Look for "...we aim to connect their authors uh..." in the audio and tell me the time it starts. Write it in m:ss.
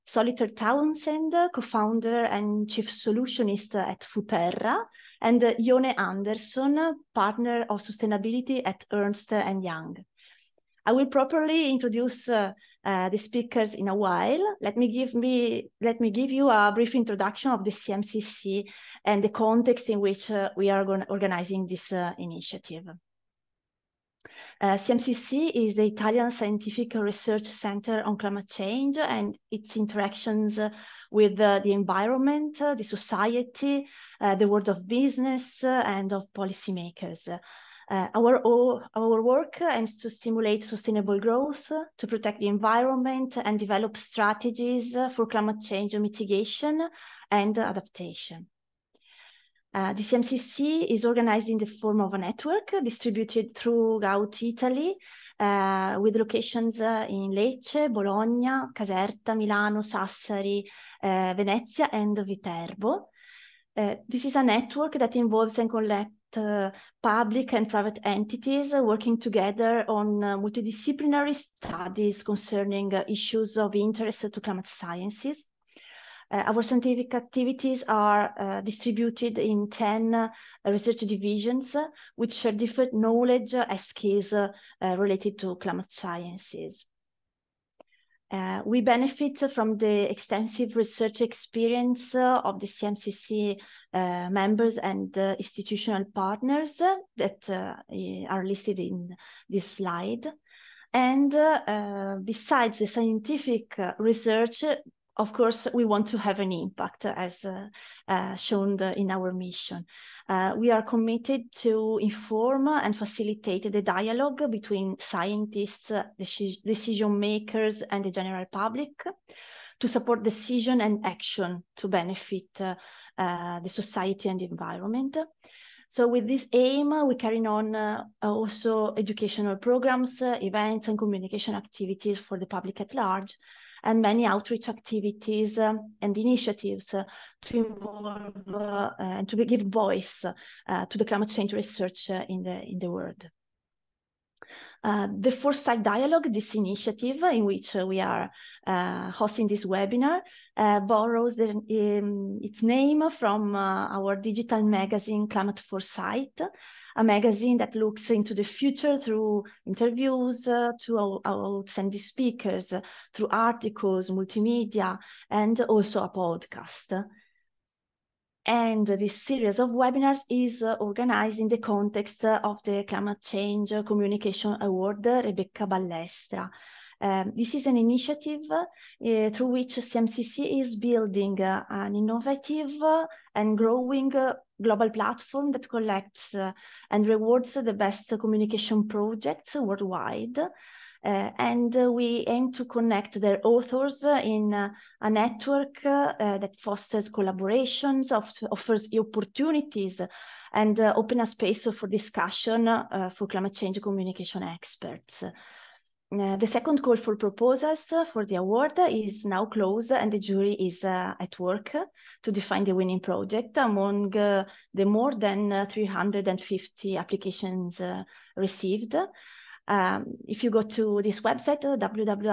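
3:11.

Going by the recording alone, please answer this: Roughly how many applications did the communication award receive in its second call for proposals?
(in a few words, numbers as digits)
More than 350.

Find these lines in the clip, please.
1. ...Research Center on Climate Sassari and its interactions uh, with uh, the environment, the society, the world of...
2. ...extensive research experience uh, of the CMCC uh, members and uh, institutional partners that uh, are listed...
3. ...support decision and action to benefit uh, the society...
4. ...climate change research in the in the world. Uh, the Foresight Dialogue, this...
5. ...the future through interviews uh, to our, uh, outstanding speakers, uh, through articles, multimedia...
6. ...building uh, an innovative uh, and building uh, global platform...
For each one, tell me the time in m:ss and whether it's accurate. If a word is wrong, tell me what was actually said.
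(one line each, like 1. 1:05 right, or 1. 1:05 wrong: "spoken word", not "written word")
1. 0:26 wrong: "Change", not "Sassari"
2. 1:30 right
3. 1:59 right
4. 2:21 right
5. 2:38 right
6. 3:00 wrong: "growing", not "building".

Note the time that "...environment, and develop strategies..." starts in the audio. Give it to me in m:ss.
0:42.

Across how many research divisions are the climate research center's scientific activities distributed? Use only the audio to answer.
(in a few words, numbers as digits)
10.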